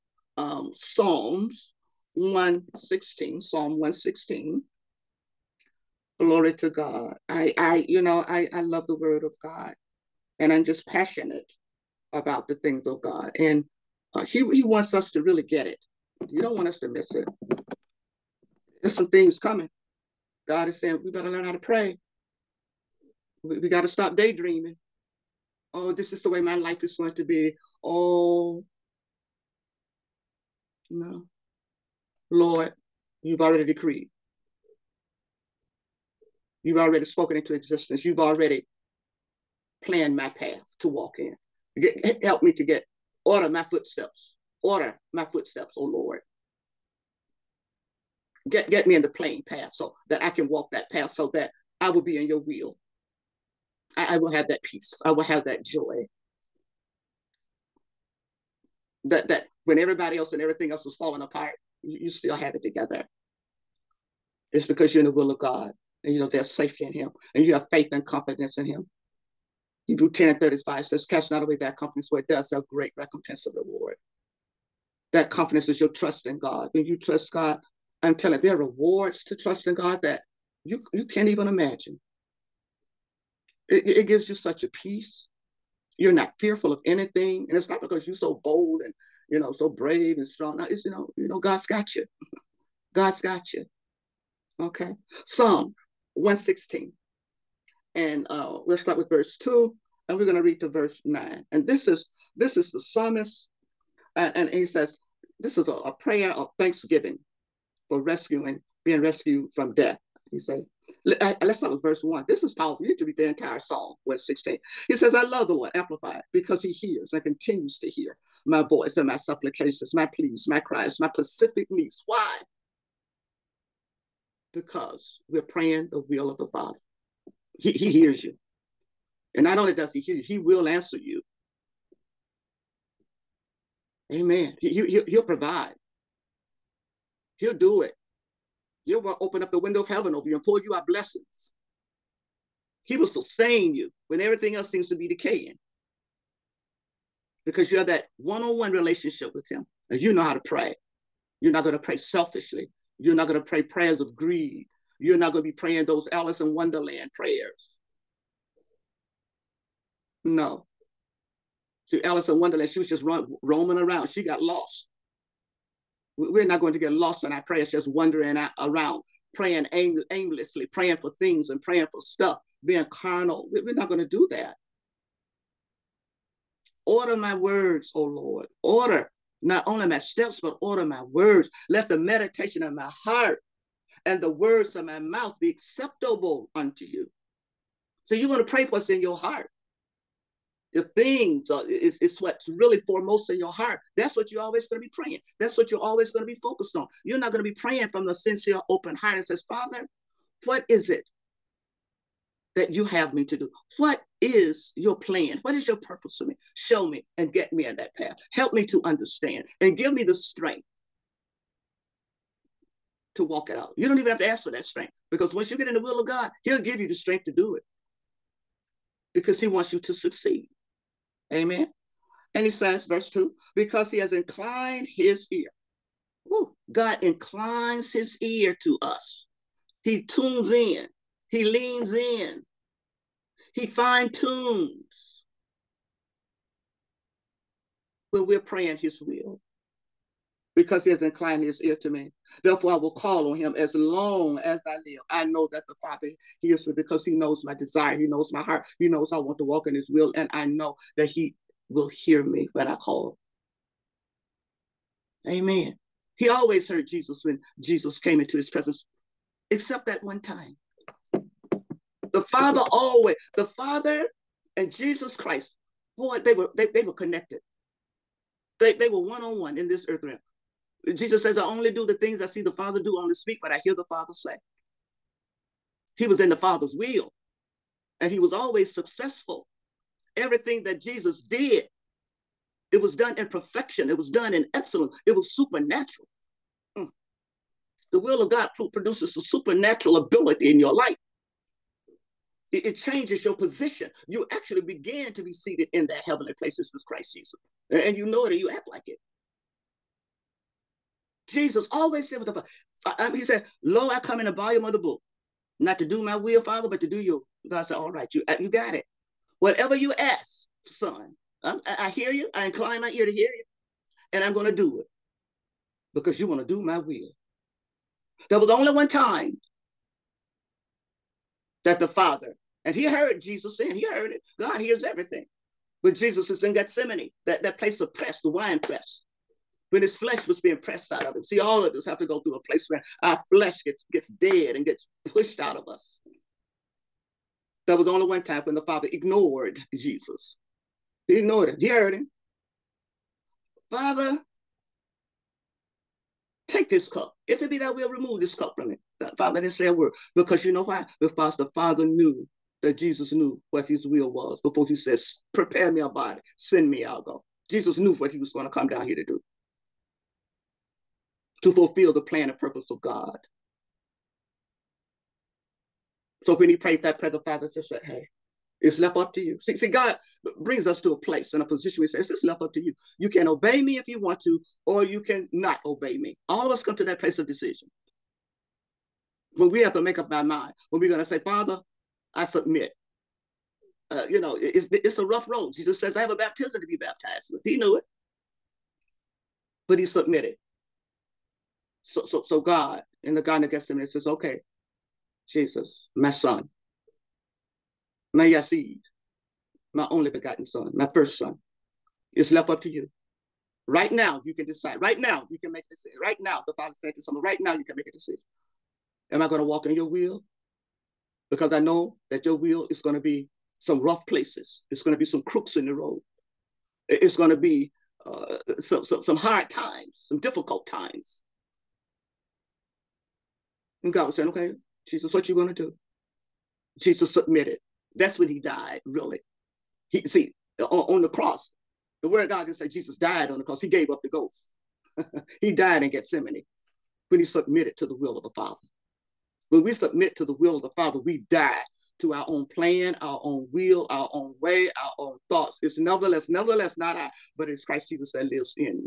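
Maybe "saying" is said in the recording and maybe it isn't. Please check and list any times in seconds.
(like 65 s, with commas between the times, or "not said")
20 s, 323 s, 424 s.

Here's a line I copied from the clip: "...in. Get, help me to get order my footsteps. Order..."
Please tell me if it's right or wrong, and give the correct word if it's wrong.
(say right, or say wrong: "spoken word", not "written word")
right.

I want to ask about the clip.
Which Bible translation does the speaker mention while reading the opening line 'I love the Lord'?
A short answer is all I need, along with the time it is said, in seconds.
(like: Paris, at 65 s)
Amplified, at 115 s.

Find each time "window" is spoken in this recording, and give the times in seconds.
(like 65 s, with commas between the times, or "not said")
139 s.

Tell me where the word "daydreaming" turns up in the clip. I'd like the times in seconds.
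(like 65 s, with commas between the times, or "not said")
24 s.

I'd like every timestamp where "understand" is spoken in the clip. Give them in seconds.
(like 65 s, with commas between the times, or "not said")
208 s.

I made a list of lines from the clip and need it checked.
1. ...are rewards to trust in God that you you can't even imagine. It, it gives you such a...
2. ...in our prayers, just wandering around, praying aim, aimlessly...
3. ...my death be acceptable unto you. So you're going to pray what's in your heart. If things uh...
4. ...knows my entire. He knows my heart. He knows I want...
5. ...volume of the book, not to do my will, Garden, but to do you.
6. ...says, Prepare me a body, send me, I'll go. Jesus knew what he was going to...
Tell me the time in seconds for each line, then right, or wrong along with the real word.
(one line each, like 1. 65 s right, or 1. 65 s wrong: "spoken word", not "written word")
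1. 78 s right
2. 167 s right
3. 184 s wrong: "mouth", not "death"
4. 247 s wrong: "desire", not "entire"
5. 304 s wrong: "Father", not "Garden"
6. 354 s right.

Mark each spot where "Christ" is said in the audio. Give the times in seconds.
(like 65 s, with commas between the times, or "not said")
265 s, 296 s, 447 s.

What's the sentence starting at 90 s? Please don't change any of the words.
Now it's, you know, you know, God's got you.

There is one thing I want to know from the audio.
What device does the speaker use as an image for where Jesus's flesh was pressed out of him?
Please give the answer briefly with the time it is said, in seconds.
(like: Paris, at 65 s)
wine press, at 328 s.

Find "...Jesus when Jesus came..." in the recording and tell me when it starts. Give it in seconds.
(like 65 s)
256 s.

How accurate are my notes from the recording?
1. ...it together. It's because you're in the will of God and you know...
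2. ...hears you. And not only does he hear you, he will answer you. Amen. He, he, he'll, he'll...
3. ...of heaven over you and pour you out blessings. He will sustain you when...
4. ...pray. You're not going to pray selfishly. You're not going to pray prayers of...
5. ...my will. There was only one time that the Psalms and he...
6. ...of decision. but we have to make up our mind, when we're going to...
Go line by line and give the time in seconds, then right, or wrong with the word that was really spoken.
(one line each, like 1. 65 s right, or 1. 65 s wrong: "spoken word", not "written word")
1. 62 s right
2. 127 s right
3. 139 s right
4. 150 s right
5. 316 s wrong: "Father", not "Psalms"
6. 377 s right.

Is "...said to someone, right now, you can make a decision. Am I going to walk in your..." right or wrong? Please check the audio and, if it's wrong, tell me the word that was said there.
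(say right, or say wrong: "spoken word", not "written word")
right.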